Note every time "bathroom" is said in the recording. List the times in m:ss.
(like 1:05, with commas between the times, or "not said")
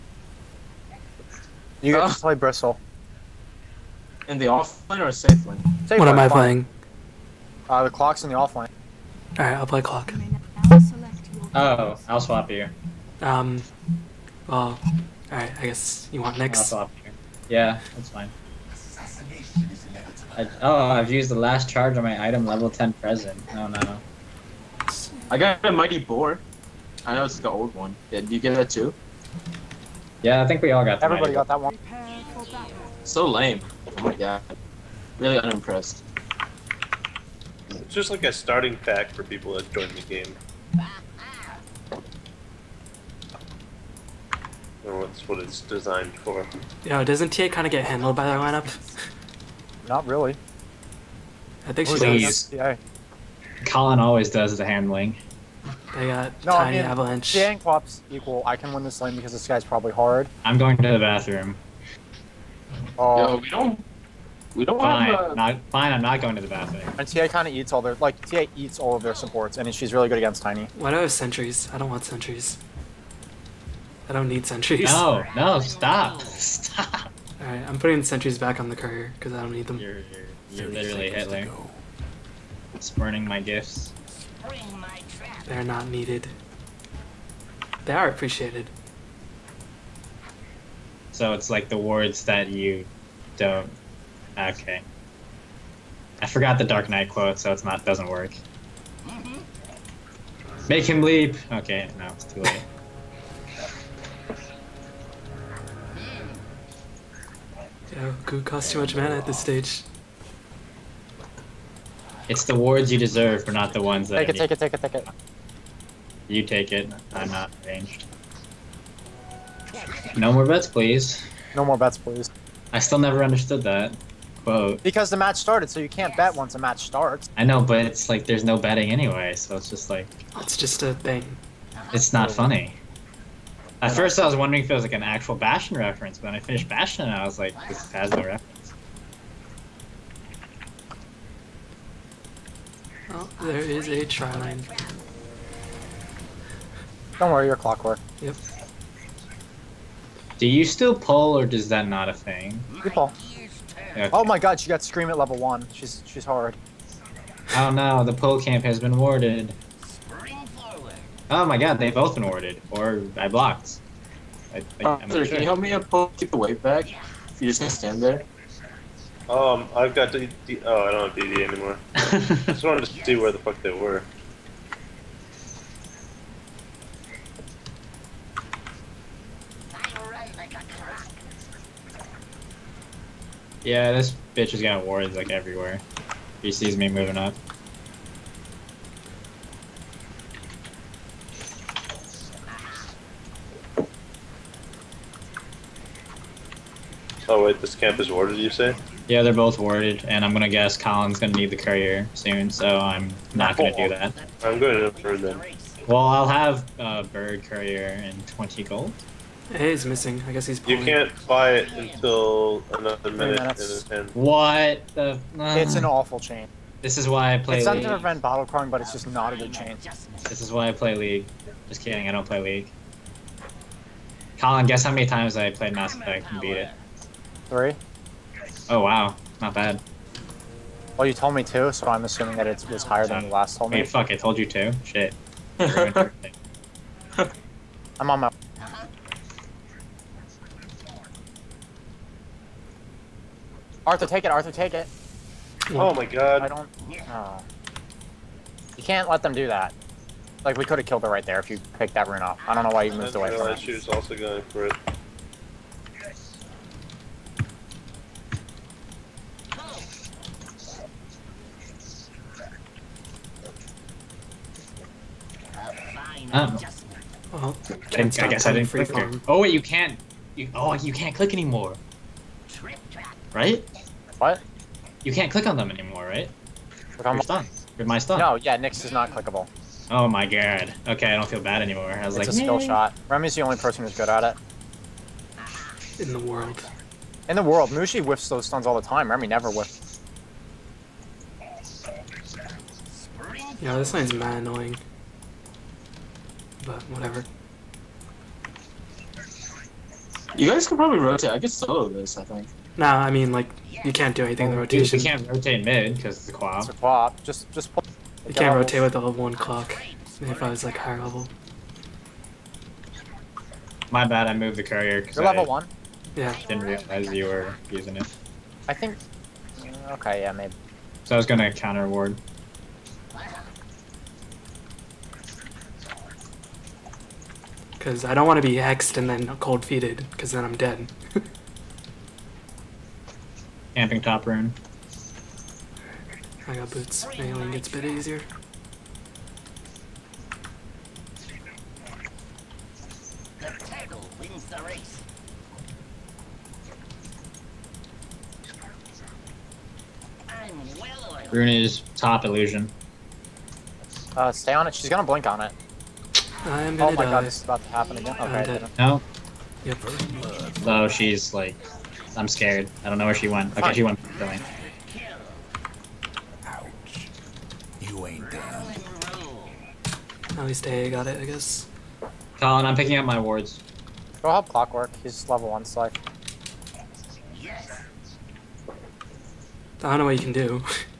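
1:00, 1:06.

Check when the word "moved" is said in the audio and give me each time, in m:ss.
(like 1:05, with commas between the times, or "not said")
4:12, 5:14.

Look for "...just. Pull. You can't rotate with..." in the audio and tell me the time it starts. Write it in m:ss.
5:07.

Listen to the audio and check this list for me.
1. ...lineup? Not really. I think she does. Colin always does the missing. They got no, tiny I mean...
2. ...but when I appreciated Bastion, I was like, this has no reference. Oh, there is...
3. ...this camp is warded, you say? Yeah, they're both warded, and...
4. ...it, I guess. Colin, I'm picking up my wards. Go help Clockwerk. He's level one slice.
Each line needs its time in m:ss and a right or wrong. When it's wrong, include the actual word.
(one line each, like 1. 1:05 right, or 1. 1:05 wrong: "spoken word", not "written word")
1. 0:48 wrong: "handling", not "missing"
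2. 2:16 wrong: "finished", not "appreciated"
3. 3:17 right
4. 6:11 right.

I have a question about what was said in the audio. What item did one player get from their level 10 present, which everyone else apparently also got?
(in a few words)
Mighty boar.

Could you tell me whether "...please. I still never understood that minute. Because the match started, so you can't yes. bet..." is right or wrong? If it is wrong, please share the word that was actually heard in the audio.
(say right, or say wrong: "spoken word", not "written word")
wrong: "quote", not "minute".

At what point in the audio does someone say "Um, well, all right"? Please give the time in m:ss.
0:13.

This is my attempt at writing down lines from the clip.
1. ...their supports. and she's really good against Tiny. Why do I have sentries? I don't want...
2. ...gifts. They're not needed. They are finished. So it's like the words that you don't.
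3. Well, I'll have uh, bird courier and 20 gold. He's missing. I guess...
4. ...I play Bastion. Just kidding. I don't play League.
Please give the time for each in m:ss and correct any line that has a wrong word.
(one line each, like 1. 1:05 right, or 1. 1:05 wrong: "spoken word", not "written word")
1. 1:09 right
2. 1:23 wrong: "appreciated", not "finished"
3. 3:25 right
4. 3:40 wrong: "League", not "Bastion".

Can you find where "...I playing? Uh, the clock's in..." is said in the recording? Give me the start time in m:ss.
0:06.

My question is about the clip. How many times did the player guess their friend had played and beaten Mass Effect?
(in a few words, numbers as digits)
3.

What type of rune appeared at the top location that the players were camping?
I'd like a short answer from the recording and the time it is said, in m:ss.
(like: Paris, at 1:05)
Illusion, at 5:52.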